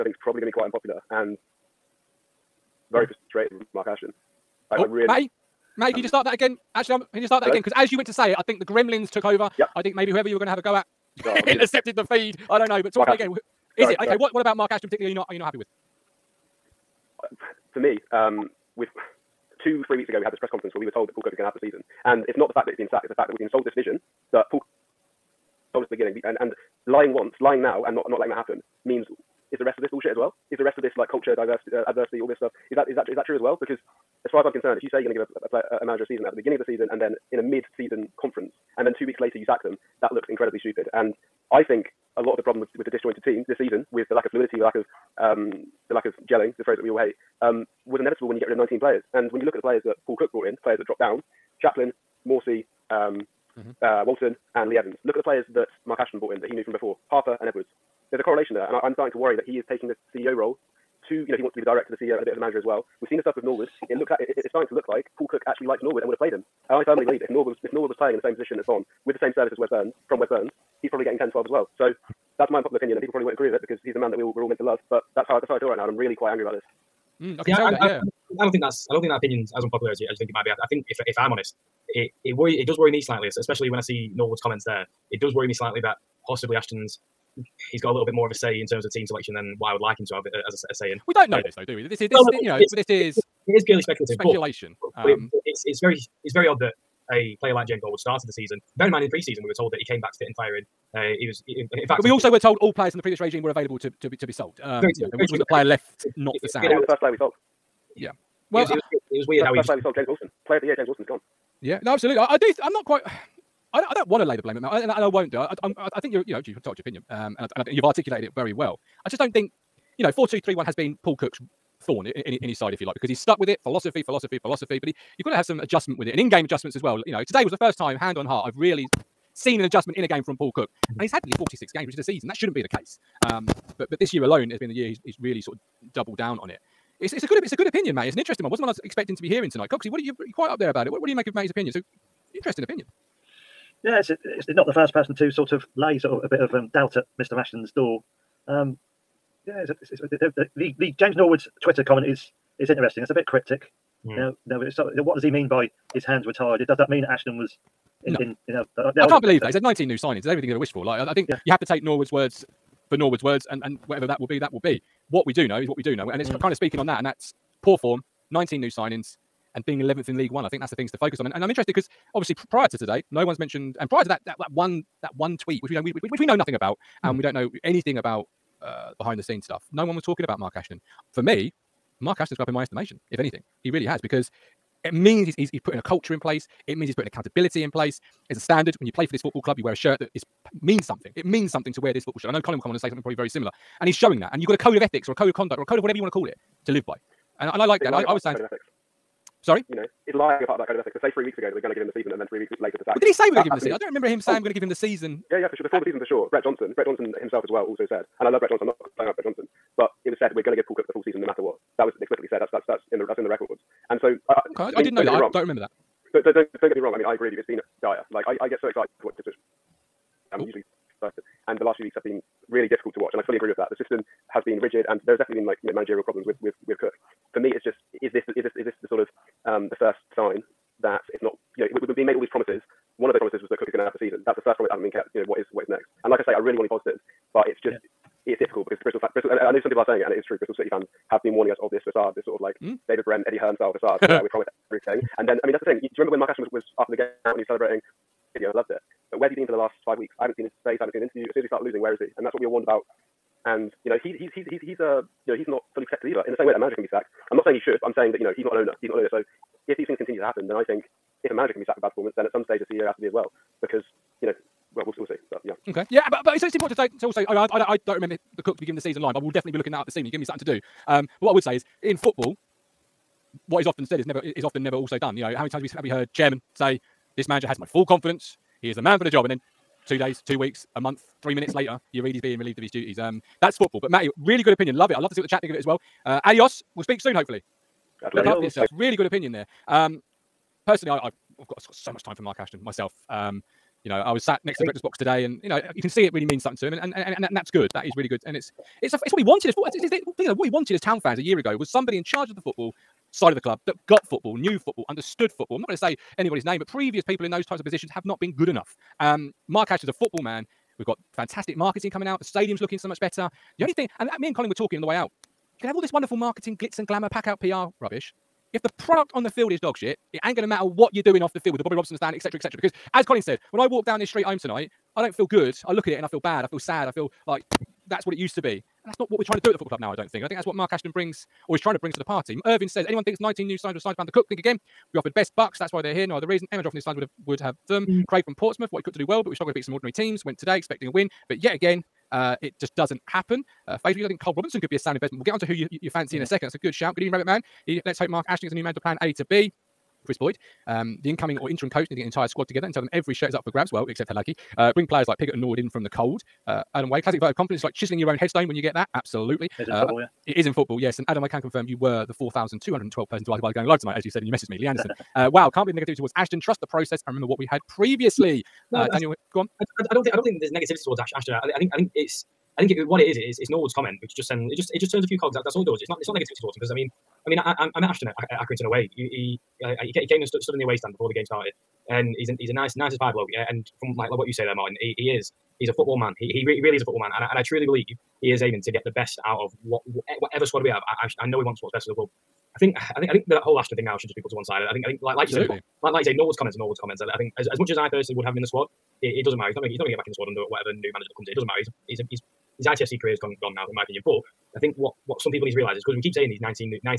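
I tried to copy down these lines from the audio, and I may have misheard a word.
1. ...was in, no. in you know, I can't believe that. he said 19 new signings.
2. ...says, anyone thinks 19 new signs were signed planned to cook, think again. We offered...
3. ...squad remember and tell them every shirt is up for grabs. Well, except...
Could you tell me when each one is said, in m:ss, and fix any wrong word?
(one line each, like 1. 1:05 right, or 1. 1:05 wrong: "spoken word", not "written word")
1. 2:37 right
2. 5:32 right
3. 5:52 wrong: "together", not "remember".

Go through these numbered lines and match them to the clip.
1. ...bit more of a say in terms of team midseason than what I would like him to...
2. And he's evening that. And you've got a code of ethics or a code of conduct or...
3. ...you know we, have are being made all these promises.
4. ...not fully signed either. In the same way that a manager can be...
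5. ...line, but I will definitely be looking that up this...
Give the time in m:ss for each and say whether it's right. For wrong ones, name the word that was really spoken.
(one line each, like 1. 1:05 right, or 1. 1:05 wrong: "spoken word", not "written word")
1. 1:28 wrong: "selection", not "midseason"
2. 3:13 wrong: "showing", not "evening"
3. 3:51 right
4. 4:15 wrong: "protected", not "signed"
5. 4:29 right.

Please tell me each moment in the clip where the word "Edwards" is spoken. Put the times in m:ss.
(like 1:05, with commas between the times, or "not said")
0:57.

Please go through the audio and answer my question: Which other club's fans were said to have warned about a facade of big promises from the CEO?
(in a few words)
Bristol City.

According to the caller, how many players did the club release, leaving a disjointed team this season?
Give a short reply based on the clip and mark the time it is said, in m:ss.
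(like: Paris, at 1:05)
19, at 0:48.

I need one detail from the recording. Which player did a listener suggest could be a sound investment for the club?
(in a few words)
Cole Robinson.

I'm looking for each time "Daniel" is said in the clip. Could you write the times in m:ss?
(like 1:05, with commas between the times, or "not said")
6:08.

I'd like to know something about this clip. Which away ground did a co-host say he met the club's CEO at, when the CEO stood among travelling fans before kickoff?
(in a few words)
Accrington.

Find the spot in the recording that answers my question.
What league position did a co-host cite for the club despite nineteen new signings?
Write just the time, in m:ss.
2:49.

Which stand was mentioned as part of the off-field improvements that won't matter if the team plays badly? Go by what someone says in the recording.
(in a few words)
Bobby Robson stand.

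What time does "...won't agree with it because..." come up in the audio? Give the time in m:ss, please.
1:13.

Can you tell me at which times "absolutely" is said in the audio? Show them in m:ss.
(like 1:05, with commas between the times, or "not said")
1:51, 5:58, 6:35.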